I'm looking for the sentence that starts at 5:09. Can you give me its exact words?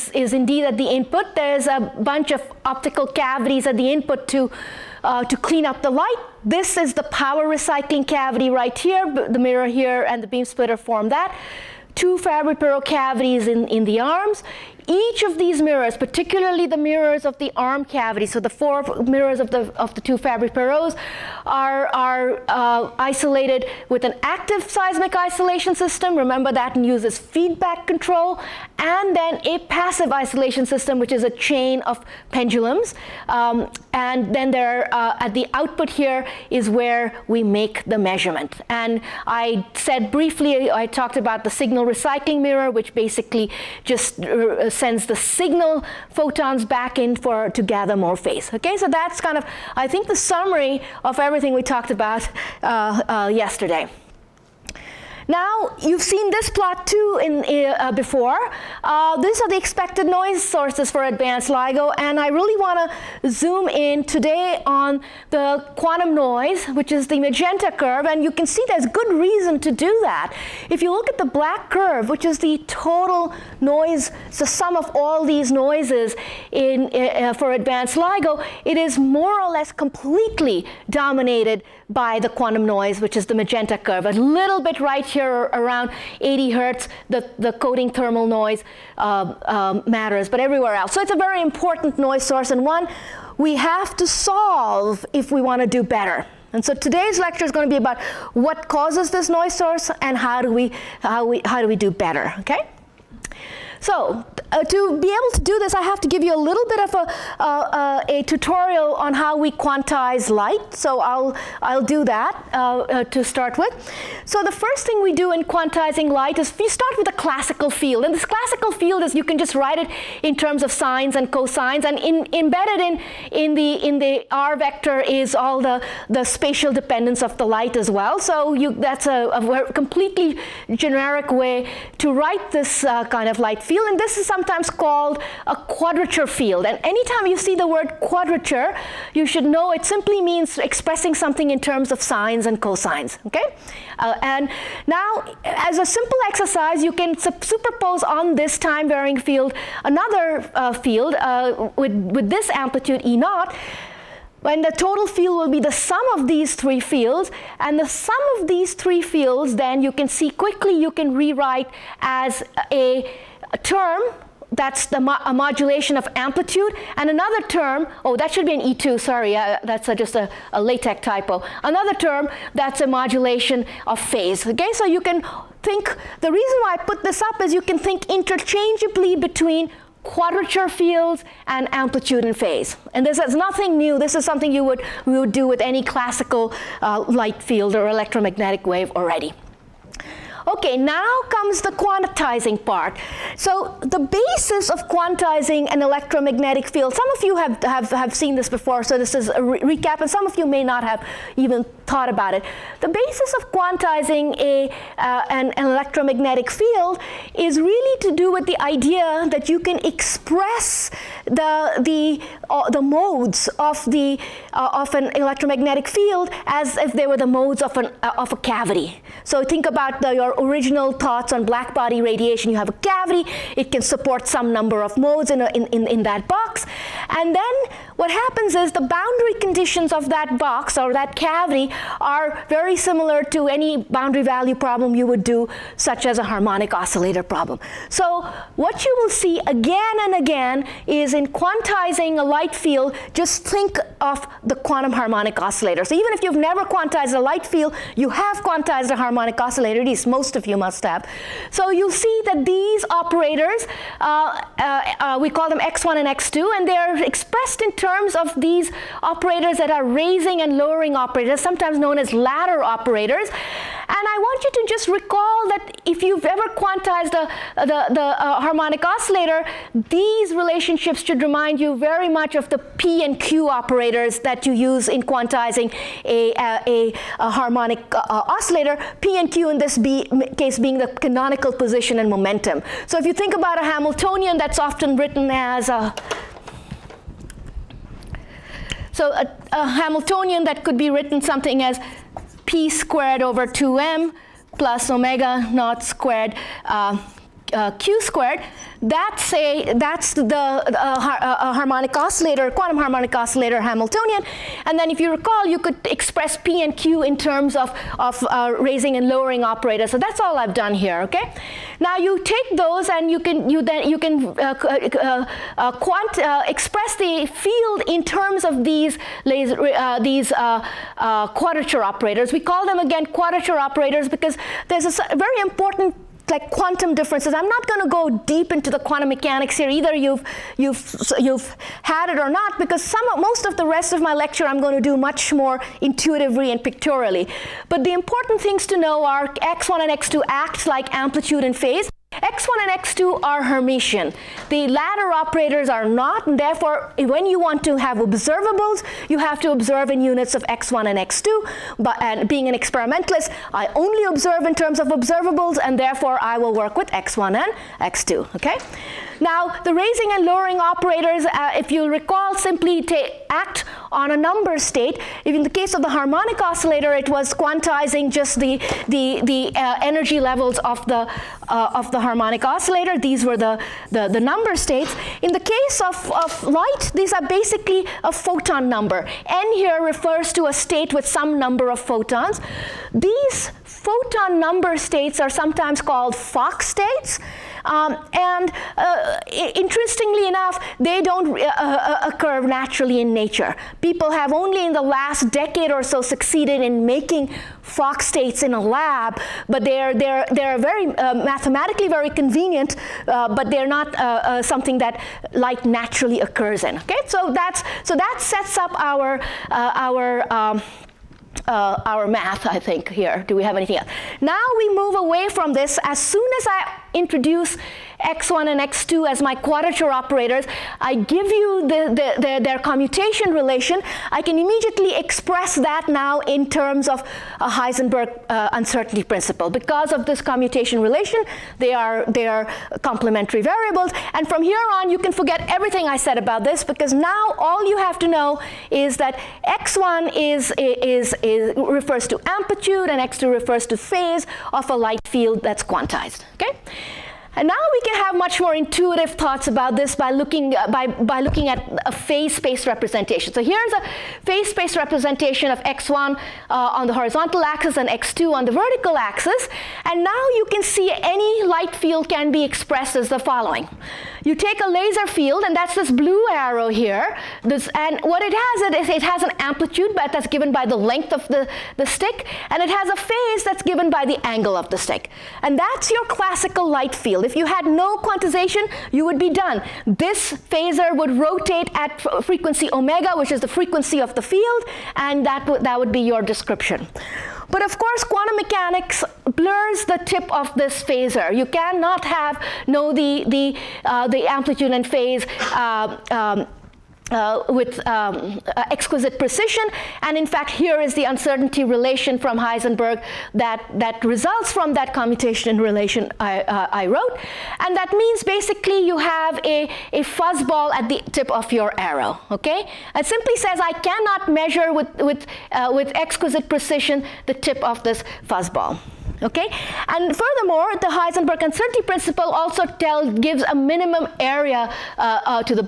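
So that's all I've done here, okay?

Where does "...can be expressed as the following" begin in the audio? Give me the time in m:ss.
7:42.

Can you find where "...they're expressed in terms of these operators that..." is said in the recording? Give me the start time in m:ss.
4:16.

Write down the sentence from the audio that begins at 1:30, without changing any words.
So it's a very important noise source and one we have to solve if we want to do better.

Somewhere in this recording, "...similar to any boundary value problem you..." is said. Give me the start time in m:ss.
3:52.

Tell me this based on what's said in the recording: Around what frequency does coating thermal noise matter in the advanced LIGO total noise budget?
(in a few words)
80 hertz.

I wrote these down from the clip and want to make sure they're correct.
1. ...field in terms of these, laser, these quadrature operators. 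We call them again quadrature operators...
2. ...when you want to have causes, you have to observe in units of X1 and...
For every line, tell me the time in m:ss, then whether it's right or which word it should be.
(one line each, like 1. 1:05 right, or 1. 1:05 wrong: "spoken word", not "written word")
1. 5:17 right
2. 5:46 wrong: "observables", not "causes".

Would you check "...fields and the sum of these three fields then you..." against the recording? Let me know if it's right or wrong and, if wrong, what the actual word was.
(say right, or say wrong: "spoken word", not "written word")
right.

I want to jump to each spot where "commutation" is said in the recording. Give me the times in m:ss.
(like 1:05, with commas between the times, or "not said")
7:02, 7:10, 8:24.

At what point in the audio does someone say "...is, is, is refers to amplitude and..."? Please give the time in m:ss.
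7:20.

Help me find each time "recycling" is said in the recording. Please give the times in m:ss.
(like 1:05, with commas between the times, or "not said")
0:07, 0:41.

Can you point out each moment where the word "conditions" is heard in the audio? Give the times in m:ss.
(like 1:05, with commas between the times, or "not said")
3:49.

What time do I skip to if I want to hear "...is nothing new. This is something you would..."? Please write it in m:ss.
3:03.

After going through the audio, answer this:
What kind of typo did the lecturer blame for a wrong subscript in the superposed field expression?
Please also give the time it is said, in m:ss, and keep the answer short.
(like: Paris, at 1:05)
LaTeX typo, at 2:50.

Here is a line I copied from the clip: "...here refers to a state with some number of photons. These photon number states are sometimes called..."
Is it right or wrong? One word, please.
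right.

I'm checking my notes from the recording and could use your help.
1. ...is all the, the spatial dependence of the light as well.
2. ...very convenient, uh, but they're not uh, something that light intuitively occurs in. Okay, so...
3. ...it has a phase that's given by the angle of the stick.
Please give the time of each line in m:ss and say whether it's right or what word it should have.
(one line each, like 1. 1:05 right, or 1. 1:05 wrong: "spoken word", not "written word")
1. 2:04 right
2. 6:41 wrong: "naturally", not "intuitively"
3. 7:52 right.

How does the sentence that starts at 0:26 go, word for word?
Remember that and uses feedback control and then a passive isolation system, which is a chain of pendulums.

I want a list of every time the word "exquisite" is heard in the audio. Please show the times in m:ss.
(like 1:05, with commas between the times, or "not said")
8:18, 8:35.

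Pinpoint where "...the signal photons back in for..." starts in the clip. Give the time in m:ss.
0:45.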